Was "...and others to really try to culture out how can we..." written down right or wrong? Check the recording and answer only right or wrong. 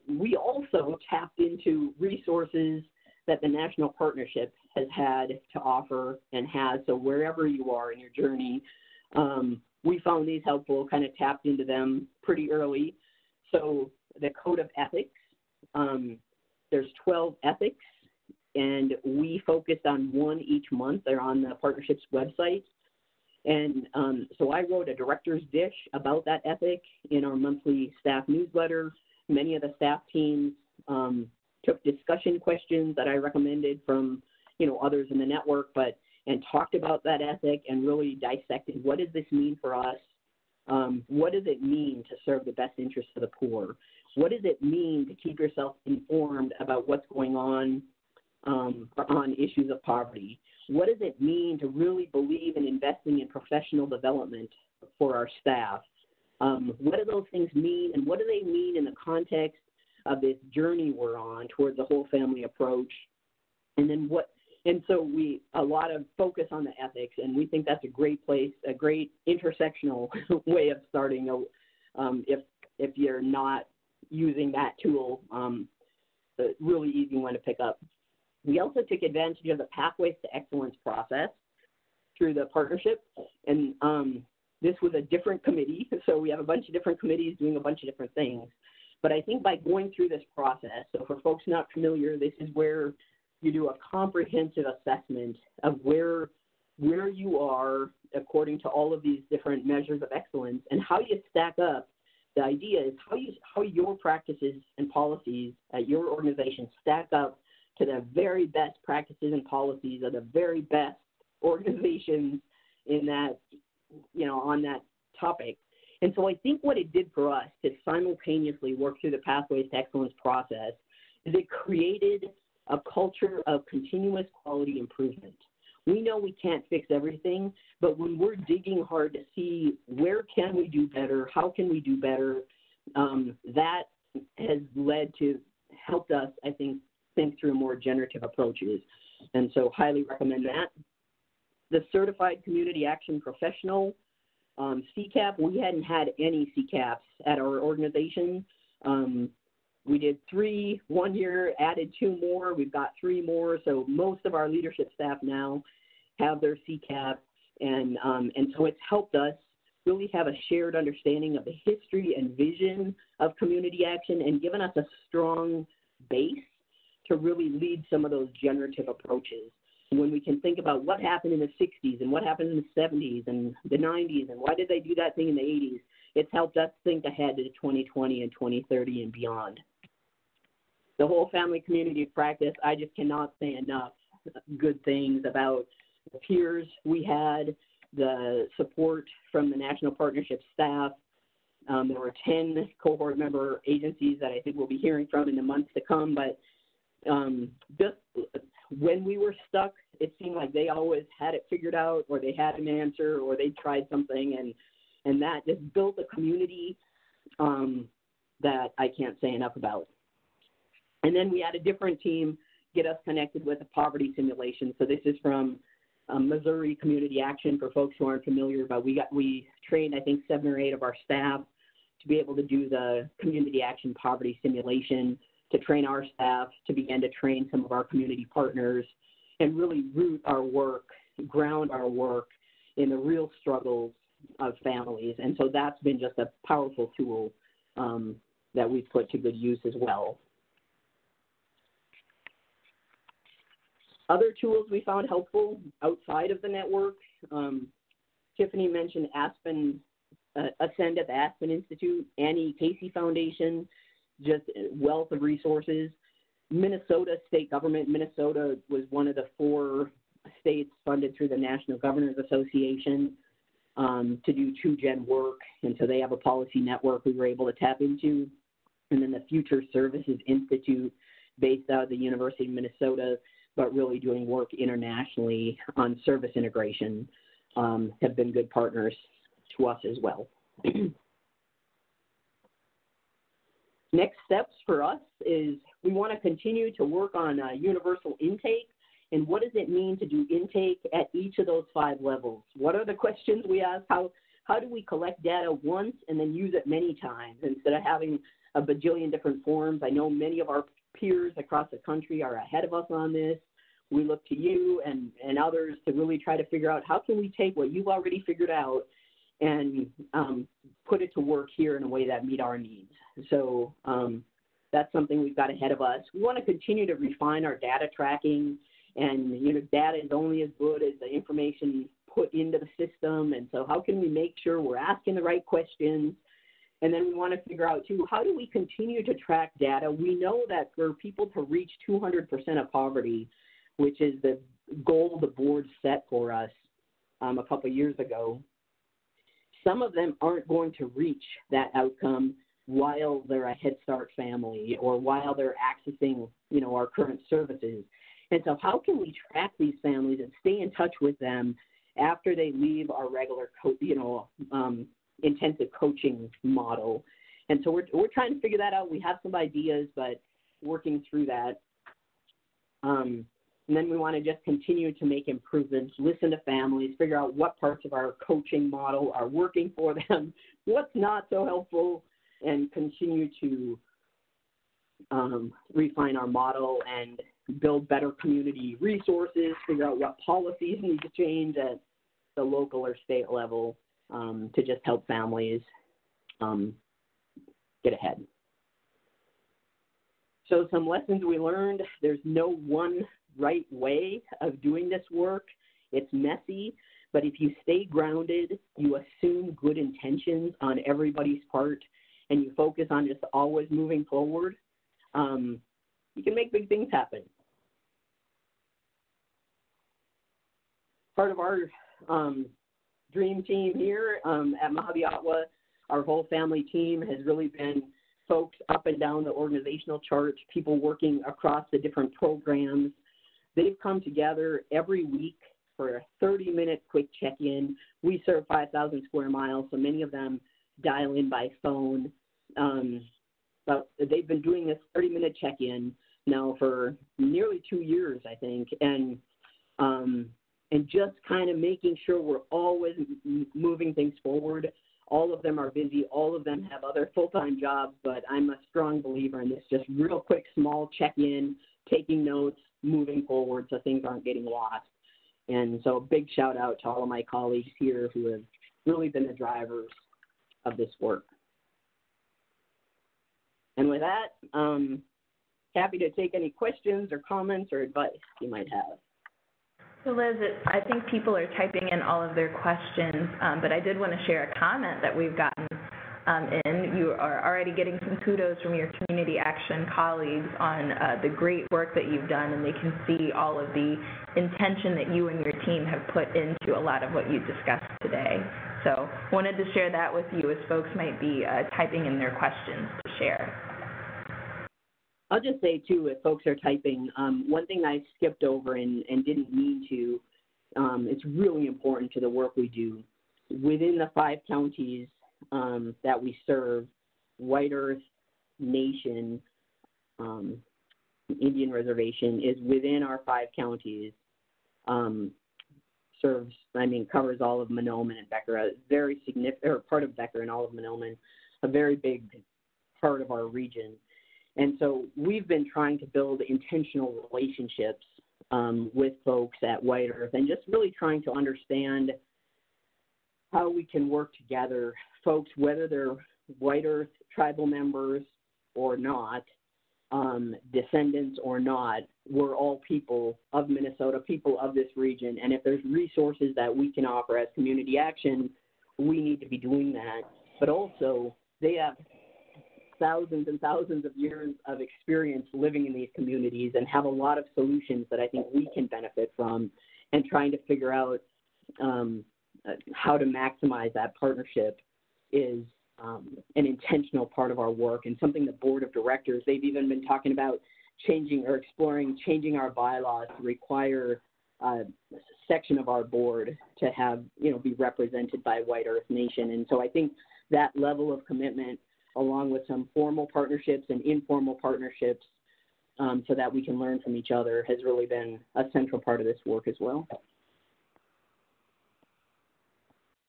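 wrong.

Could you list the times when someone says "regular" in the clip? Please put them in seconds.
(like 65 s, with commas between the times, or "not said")
353 s.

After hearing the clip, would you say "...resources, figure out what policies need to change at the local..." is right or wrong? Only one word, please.
right.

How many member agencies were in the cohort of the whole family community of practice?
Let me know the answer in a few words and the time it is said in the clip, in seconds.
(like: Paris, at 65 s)
10, at 192 s.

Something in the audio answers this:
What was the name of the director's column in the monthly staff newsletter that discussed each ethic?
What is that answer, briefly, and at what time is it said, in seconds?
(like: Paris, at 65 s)
director's dish, at 24 s.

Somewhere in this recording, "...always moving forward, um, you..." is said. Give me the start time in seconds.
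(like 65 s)
403 s.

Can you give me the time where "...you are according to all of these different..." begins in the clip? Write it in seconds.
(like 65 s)
97 s.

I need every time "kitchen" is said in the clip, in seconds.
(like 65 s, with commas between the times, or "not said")
not said.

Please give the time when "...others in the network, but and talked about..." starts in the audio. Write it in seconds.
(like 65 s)
34 s.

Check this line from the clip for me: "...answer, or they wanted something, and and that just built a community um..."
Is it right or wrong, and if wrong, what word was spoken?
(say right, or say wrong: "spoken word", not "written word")
wrong: "tried", not "wanted".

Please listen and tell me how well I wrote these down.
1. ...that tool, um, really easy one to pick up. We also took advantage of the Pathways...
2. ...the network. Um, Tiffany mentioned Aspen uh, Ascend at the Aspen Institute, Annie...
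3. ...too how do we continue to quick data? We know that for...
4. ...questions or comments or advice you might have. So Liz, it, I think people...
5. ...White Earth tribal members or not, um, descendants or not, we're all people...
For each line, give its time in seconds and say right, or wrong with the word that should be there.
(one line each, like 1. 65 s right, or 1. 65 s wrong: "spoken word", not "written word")
1. 74 s right
2. 246 s right
3. 327 s wrong: "track", not "quick"
4. 466 s right
5. 536 s right.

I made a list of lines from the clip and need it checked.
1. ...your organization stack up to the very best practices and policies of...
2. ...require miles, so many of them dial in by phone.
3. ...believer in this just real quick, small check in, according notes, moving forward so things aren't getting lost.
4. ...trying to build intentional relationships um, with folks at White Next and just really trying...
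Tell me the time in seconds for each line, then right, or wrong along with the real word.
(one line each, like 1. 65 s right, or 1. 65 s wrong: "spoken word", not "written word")
1. 105 s right
2. 429 s wrong: "square", not "require"
3. 449 s wrong: "taking", not "according"
4. 525 s wrong: "Earth", not "Next".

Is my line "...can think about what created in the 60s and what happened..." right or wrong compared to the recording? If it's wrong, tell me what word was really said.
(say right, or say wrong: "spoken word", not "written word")
wrong: "happened", not "created".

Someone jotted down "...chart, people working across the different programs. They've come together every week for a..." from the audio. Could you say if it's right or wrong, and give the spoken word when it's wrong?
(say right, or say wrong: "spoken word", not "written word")
right.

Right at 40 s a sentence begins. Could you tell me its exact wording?
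Um, what does it mean to serve the best interests of the poor?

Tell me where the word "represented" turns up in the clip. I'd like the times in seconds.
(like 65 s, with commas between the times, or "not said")
577 s.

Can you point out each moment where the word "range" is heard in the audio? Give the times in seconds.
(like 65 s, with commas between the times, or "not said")
not said.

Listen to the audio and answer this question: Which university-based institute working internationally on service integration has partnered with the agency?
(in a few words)
Future Services Institute.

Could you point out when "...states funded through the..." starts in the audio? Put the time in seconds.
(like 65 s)
260 s.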